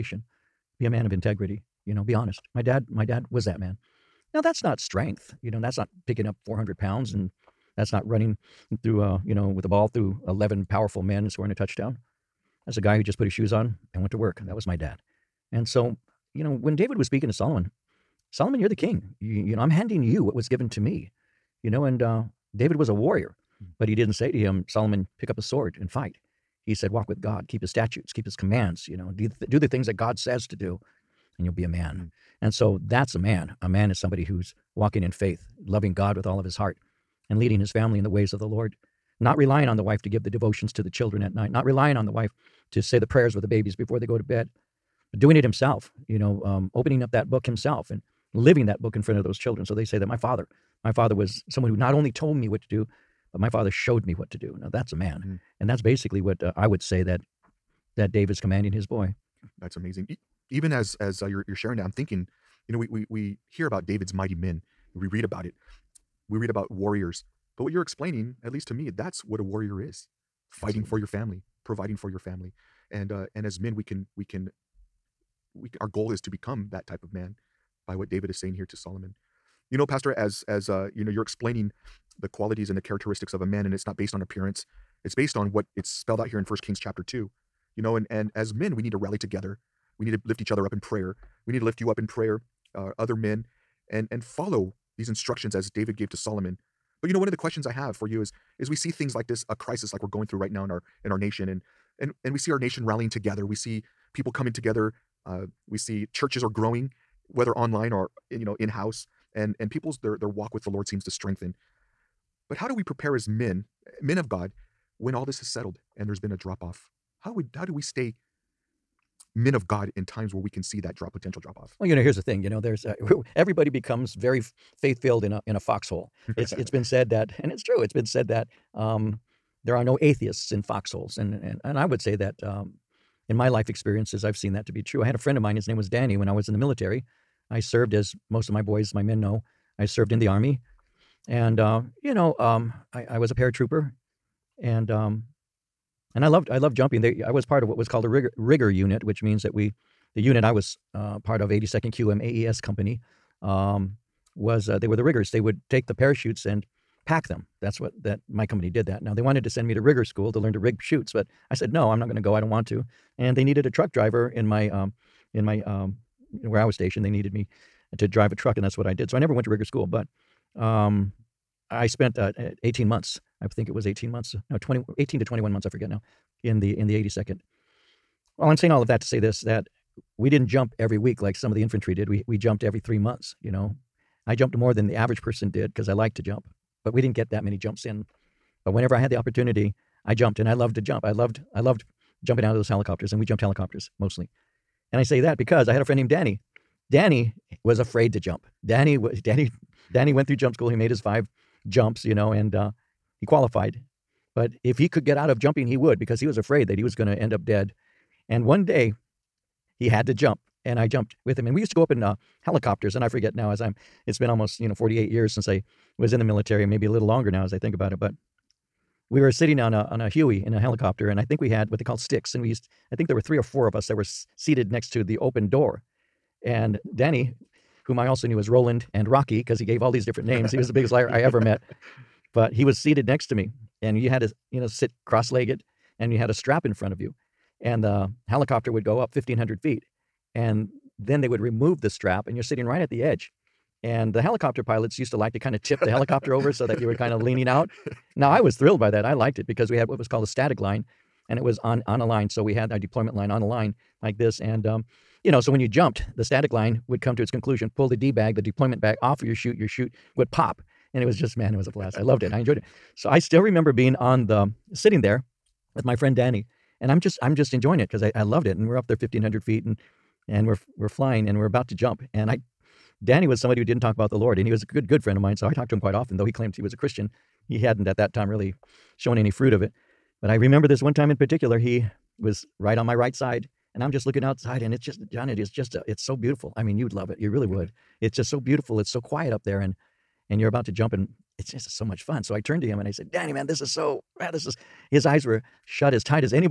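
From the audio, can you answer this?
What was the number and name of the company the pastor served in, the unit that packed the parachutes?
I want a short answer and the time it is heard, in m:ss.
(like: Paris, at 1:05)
82nd AES Company, at 2:31.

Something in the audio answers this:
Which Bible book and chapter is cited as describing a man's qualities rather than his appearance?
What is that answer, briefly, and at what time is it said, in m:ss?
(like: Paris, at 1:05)
First Kings chapter 2, at 1:26.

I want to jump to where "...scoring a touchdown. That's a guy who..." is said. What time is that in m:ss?
0:11.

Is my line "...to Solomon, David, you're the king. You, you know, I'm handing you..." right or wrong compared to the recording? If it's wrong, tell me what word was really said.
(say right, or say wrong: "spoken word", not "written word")
wrong: "Solomon", not "David".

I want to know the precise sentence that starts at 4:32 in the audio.
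And I, Danny was somebody who didn't talk about the Lord, and he was a good, good friend of mine.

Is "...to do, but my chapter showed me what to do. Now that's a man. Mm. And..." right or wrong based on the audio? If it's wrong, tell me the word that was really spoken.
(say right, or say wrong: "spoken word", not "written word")
wrong: "father", not "chapter".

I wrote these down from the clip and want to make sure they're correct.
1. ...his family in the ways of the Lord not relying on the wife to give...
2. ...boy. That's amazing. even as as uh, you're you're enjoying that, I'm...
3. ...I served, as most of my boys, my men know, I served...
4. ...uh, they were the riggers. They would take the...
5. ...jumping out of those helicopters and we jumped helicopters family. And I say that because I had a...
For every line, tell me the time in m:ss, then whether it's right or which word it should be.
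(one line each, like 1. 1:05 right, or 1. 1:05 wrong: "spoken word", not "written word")
1. 0:37 right
2. 0:58 wrong: "sharing", not "enjoying"
3. 2:17 right
4. 2:34 right
5. 3:12 wrong: "mostly", not "family".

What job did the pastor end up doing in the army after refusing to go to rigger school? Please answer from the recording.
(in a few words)
Truck driver.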